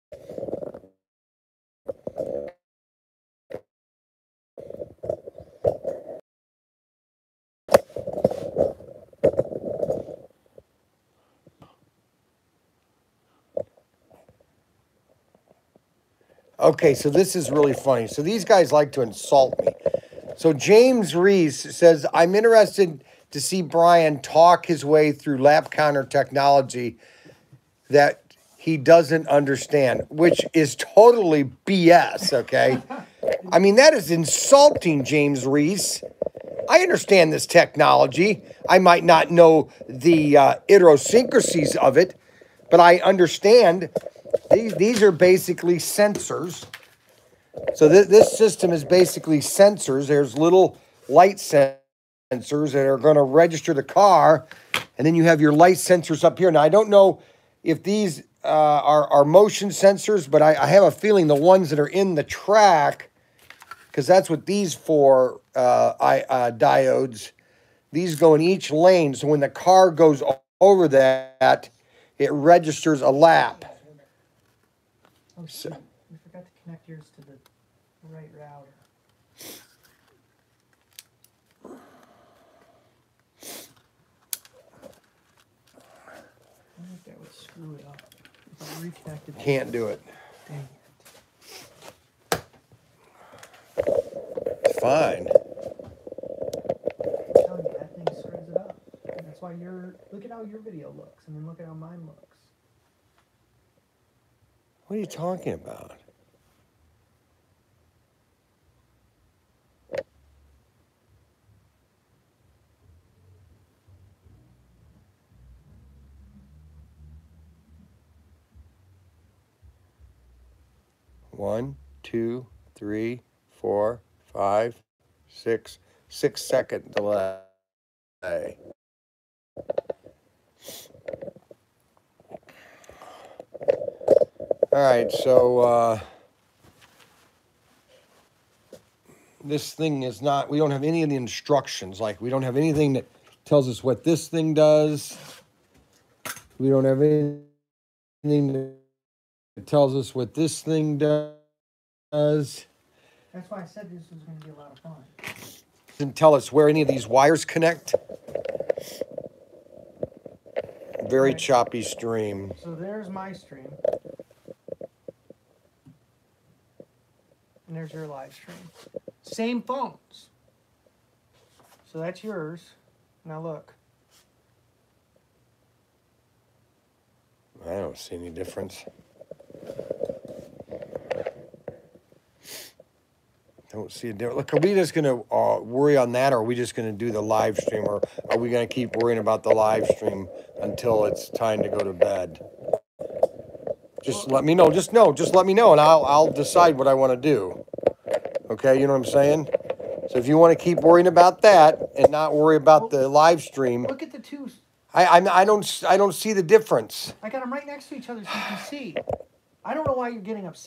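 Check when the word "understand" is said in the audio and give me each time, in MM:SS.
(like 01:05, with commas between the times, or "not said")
00:29, 00:36, 00:42.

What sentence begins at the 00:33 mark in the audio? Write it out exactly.
I mean, that is insulting, James Reese.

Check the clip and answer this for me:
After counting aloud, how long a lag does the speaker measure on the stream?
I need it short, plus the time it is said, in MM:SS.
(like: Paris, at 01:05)
6 seconds, at 02:06.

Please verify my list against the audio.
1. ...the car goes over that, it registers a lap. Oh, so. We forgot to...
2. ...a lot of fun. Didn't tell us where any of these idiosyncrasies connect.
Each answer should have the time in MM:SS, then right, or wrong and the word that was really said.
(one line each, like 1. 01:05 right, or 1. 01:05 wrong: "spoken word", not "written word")
1. 01:09 right
2. 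02:34 wrong: "wires", not "idiosyncrasies".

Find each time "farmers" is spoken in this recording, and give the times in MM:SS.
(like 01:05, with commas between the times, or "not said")
not said.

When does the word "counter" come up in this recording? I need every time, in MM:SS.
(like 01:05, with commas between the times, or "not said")
00:25.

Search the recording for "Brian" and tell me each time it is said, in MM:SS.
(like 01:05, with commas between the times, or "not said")
00:23.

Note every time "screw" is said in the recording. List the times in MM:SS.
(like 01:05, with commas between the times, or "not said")
01:27, 01:38.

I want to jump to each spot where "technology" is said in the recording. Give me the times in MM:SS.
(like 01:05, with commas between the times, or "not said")
00:26, 00:37.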